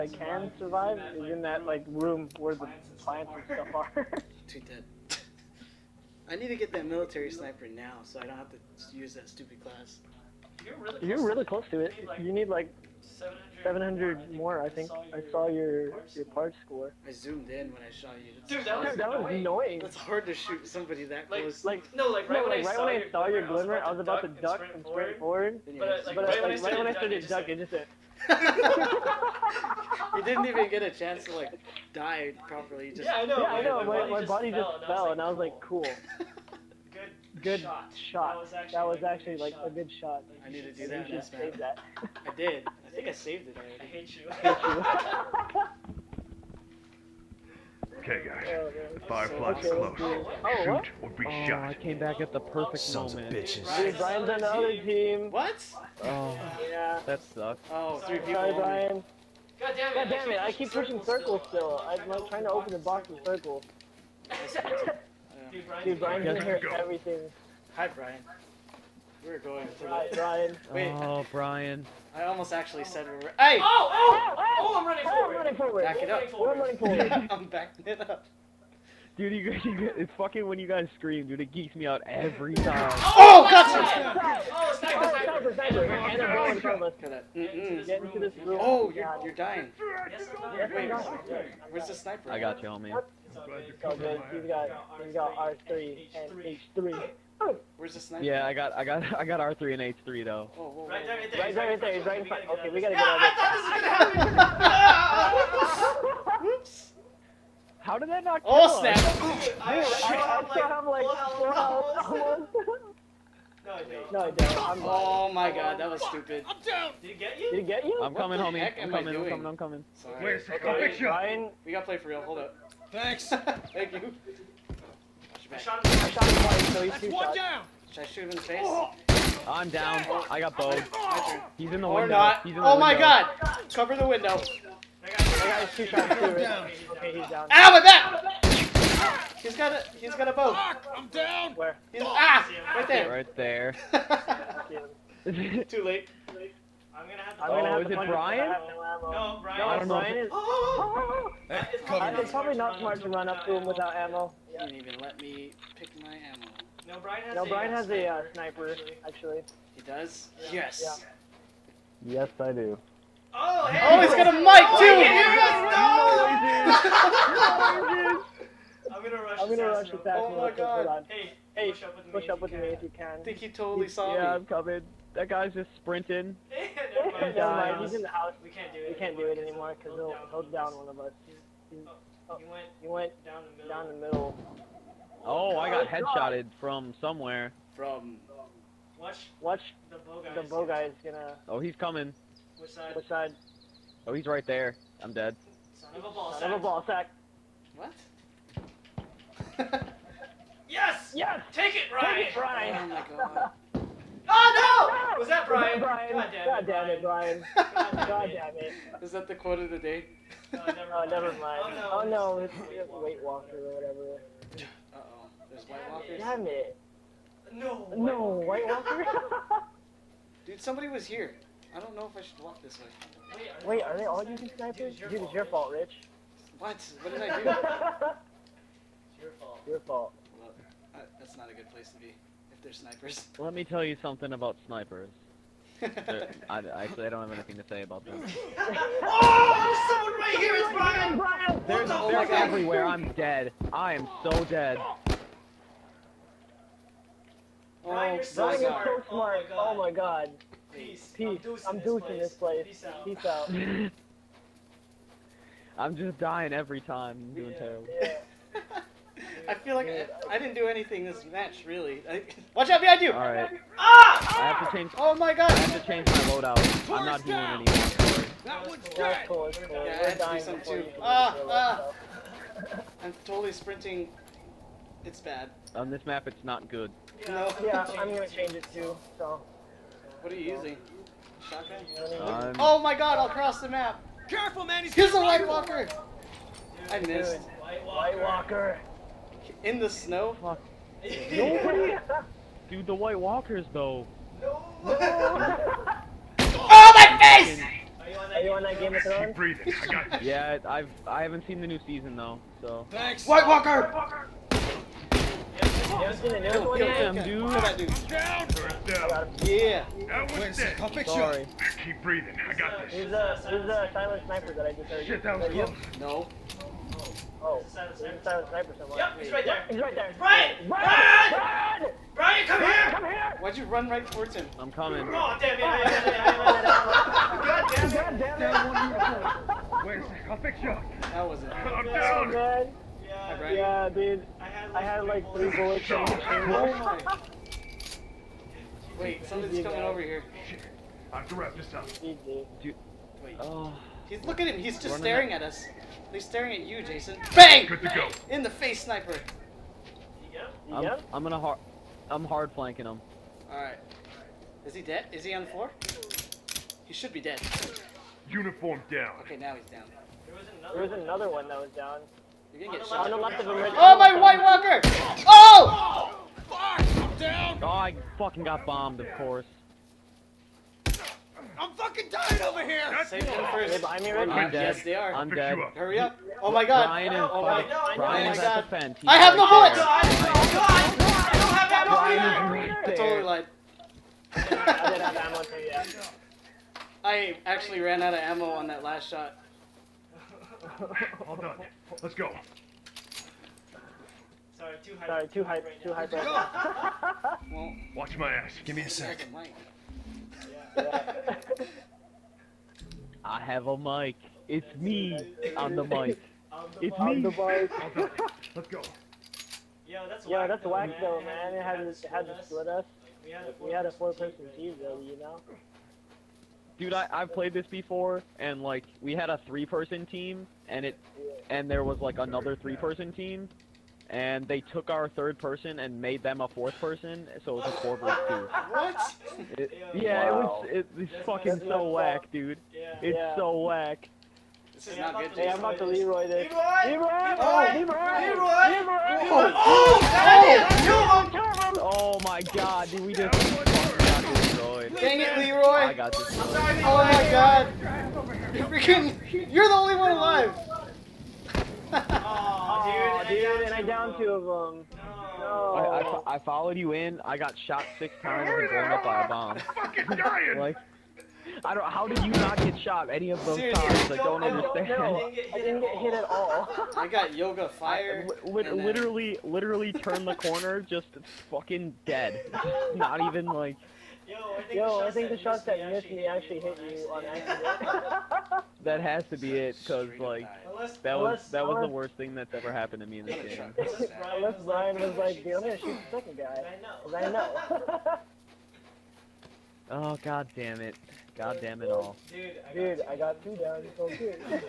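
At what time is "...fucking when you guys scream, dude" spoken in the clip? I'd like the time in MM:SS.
01:20.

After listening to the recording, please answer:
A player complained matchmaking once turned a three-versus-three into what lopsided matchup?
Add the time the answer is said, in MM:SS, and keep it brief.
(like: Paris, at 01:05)
four versus two, at 07:07.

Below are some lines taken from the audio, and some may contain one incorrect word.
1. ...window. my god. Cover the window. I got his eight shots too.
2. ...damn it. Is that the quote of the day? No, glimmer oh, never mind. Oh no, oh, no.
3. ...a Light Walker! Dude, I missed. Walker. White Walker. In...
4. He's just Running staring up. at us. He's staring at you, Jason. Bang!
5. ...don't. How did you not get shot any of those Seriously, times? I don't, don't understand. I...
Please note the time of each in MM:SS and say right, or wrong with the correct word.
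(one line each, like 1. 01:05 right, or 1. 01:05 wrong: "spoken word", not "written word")
1. 02:12 wrong: "two", not "eight"
2. 03:28 wrong: "never", not "glimmer"
3. 04:45 right
4. 05:44 right
5. 07:41 right.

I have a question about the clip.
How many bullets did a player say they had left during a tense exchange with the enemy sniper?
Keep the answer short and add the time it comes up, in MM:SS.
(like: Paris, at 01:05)
3, at 05:35.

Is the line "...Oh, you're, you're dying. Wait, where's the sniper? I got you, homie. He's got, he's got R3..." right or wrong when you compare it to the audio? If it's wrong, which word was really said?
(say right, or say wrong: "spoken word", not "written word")
right.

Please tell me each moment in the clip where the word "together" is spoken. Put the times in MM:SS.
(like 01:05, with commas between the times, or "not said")
not said.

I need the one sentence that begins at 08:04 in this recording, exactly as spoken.
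unless Ryan was like, the I'm gonna shoot the second guy." I know.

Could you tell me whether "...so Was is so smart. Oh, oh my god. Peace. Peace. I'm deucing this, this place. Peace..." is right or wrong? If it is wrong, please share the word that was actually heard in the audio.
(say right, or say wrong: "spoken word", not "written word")
wrong: "Brian", not "Was".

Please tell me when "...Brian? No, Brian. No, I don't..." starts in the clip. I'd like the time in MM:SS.
02:28.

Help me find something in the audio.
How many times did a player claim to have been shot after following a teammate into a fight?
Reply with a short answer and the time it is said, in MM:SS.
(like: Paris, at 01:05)
6, at 07:37.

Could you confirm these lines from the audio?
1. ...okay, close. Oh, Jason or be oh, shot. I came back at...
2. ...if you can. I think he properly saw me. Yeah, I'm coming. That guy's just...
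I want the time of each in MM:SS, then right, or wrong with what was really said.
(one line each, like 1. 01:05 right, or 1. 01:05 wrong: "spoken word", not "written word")
1. 00:49 wrong: "Shoot", not "Jason"
2. 02:52 wrong: "totally", not "properly".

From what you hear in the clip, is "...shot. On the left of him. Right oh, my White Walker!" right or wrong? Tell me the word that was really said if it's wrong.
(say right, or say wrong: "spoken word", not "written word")
right.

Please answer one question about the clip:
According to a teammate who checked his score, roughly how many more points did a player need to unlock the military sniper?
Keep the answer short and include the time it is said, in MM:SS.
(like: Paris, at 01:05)
700, at 00:13.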